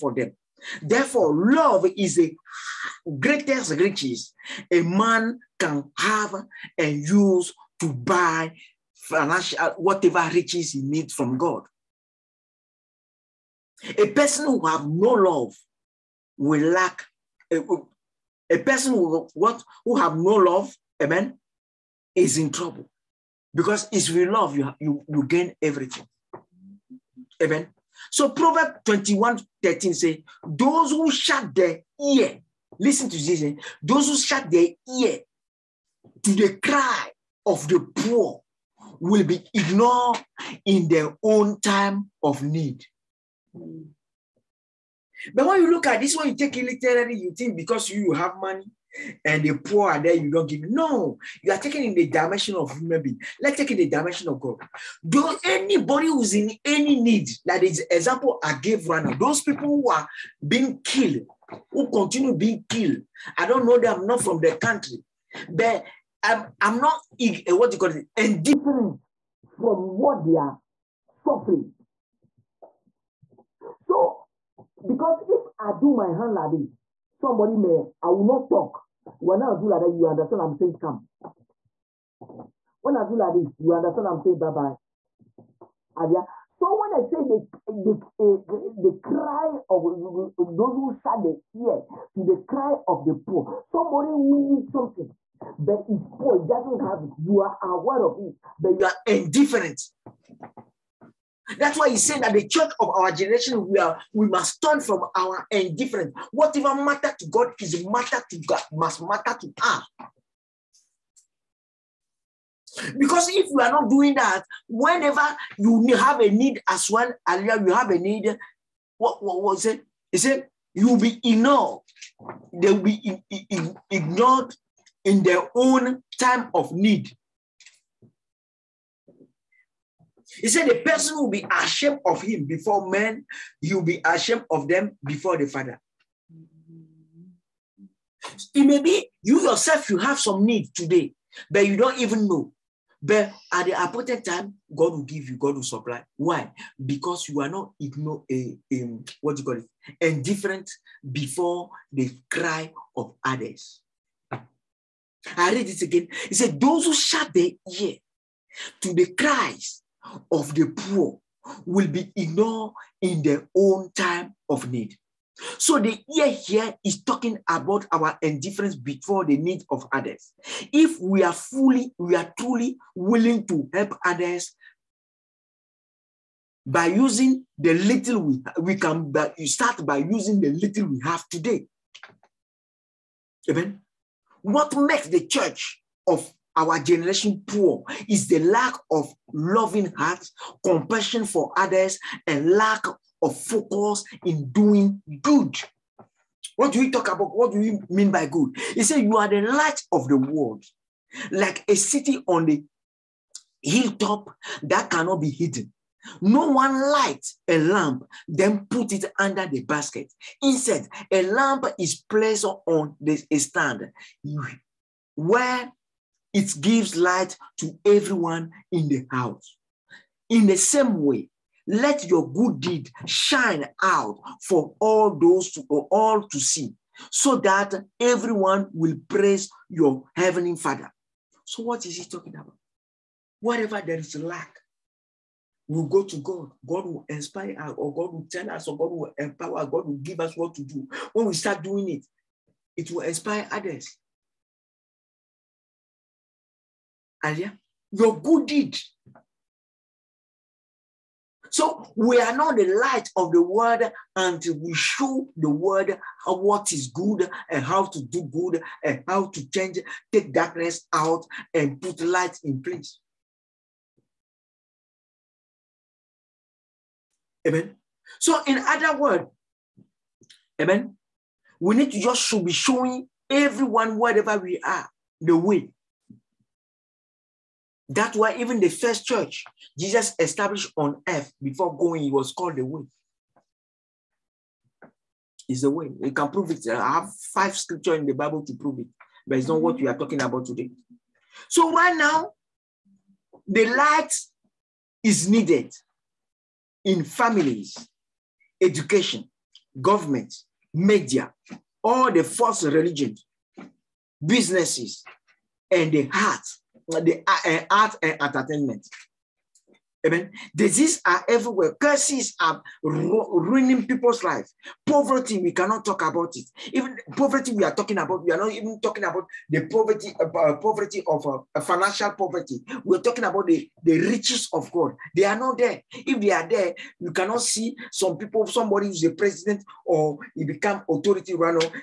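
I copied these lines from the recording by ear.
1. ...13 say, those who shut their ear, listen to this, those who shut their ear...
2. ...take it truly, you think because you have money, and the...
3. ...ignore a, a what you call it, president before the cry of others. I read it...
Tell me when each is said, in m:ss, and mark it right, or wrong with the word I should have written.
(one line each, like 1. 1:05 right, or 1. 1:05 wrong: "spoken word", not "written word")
1. 0:29 right
2. 0:46 wrong: "literally", not "truly"
3. 2:27 wrong: "indifferent", not "president".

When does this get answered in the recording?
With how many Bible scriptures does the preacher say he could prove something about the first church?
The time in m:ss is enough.
4:47.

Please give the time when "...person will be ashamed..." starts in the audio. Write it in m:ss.
2:10.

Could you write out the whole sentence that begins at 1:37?
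You are aware of it, but you are indifferent.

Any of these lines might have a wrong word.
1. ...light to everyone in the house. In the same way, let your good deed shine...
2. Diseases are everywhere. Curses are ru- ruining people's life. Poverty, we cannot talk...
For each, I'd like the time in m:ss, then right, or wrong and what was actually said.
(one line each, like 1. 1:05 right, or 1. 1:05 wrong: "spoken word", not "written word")
1. 3:36 right
2. 5:10 right.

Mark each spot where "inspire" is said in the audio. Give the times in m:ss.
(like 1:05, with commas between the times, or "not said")
3:57, 4:03.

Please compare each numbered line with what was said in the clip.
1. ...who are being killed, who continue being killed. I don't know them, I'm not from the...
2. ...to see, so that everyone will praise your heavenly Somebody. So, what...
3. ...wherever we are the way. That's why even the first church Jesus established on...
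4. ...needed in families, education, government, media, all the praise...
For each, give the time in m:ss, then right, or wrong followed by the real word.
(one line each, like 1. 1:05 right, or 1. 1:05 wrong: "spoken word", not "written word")
1. 0:59 right
2. 3:46 wrong: "Father", not "Somebody"
3. 4:33 right
4. 4:55 wrong: "false", not "praise".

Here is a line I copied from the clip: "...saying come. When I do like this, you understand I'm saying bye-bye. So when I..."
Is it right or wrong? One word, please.
right.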